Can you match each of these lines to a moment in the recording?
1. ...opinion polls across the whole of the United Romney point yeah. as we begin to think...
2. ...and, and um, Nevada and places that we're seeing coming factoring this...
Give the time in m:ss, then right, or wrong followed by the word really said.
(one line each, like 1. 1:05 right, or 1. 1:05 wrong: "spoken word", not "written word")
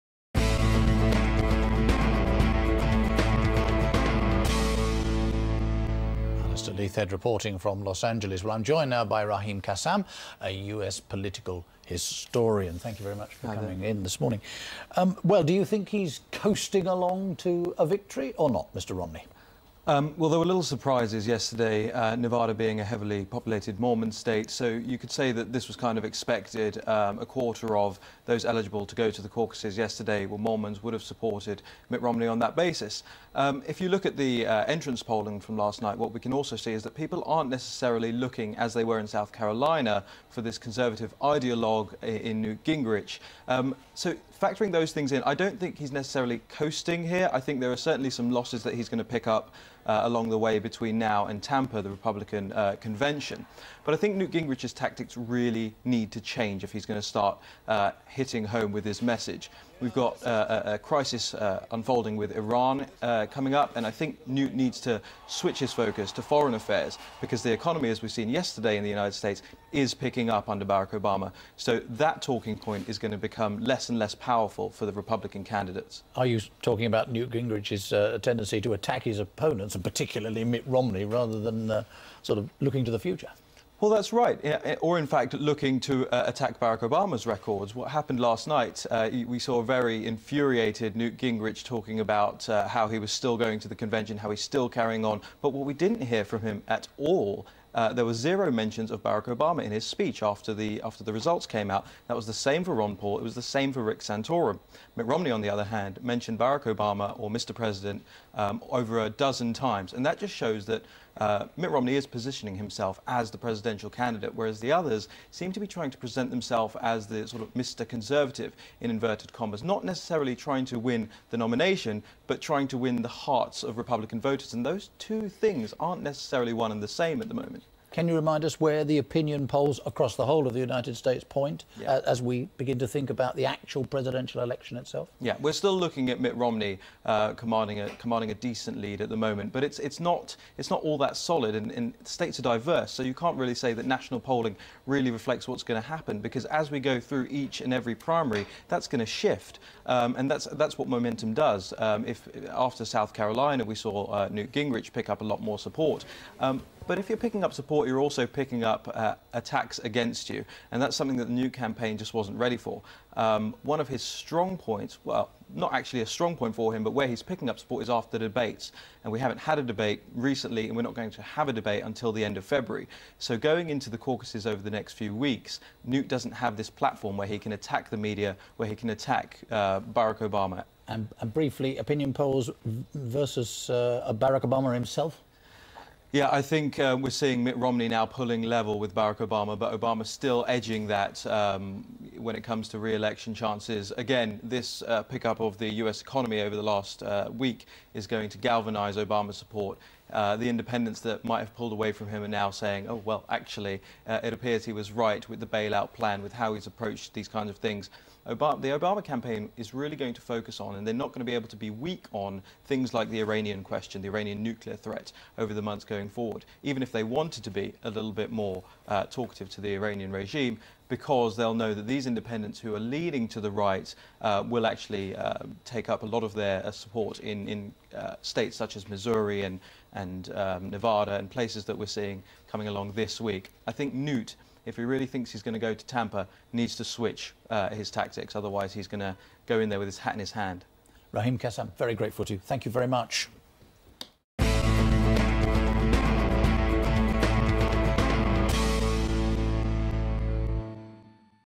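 1. 2:08 wrong: "States", not "Romney"
2. 3:49 wrong: "along", not "factoring".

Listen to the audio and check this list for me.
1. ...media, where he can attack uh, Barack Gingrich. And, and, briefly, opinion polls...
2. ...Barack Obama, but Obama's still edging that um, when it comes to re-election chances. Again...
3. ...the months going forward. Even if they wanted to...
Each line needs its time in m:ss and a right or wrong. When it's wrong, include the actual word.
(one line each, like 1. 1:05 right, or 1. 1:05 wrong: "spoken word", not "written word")
1. 2:57 wrong: "Obama", not "Gingrich"
2. 3:08 right
3. 3:35 right.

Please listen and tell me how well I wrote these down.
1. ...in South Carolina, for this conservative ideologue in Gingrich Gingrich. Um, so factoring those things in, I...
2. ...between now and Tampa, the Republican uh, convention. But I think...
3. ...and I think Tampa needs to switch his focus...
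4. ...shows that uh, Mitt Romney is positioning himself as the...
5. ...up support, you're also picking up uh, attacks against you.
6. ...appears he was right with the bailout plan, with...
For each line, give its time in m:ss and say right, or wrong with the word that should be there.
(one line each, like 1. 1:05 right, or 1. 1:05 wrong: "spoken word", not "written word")
1. 0:38 wrong: "Newt", not "Gingrich"
2. 0:50 right
3. 1:03 wrong: "Newt", not "Tampa"
4. 1:50 right
5. 2:37 right
6. 3:24 right.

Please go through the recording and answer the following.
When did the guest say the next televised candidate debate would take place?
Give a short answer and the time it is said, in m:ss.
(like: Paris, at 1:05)
End of February, at 2:52.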